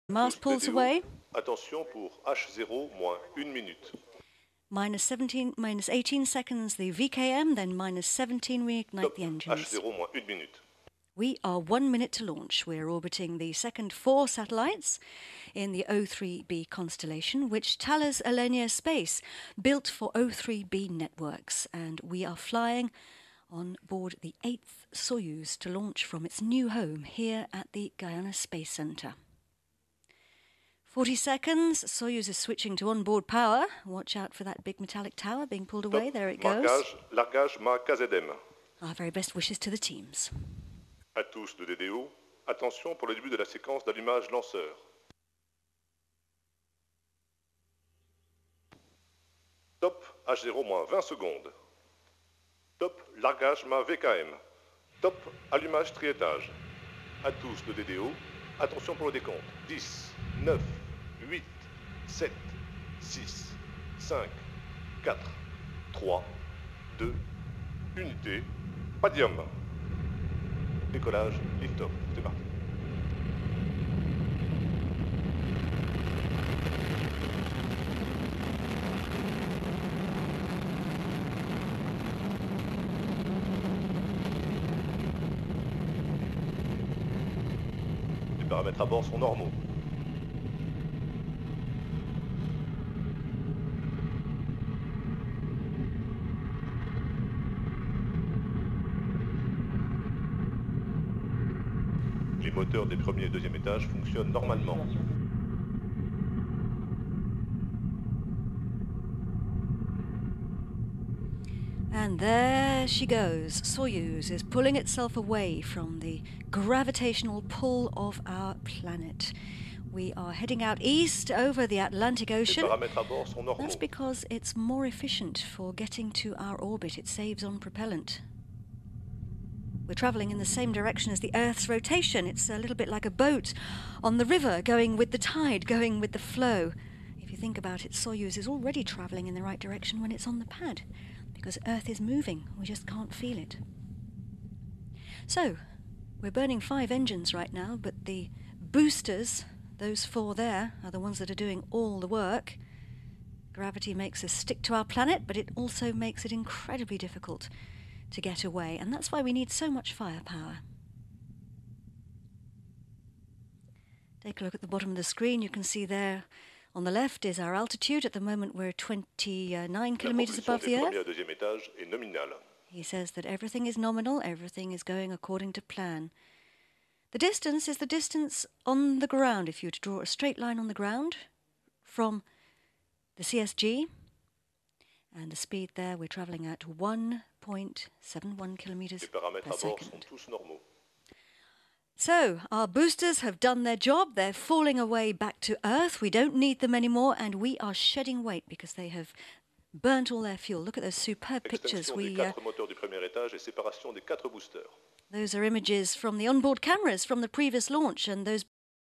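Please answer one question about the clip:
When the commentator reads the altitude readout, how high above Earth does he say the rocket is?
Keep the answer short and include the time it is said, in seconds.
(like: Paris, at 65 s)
29 kilometers, at 168 s.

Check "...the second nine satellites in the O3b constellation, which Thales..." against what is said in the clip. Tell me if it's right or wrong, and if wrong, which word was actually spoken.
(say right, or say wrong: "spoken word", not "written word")
wrong: "four", not "nine".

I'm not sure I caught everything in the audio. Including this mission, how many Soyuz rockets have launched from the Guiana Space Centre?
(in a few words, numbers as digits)
8.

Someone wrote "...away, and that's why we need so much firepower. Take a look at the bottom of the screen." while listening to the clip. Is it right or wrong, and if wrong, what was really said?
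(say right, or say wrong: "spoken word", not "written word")
right.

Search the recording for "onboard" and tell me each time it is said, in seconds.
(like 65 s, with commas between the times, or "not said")
32 s, 206 s.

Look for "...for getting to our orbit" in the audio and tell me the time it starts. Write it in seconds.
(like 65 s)
125 s.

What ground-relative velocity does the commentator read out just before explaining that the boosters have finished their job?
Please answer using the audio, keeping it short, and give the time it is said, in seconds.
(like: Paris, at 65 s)
1.71 kilometres per second, at 186 s.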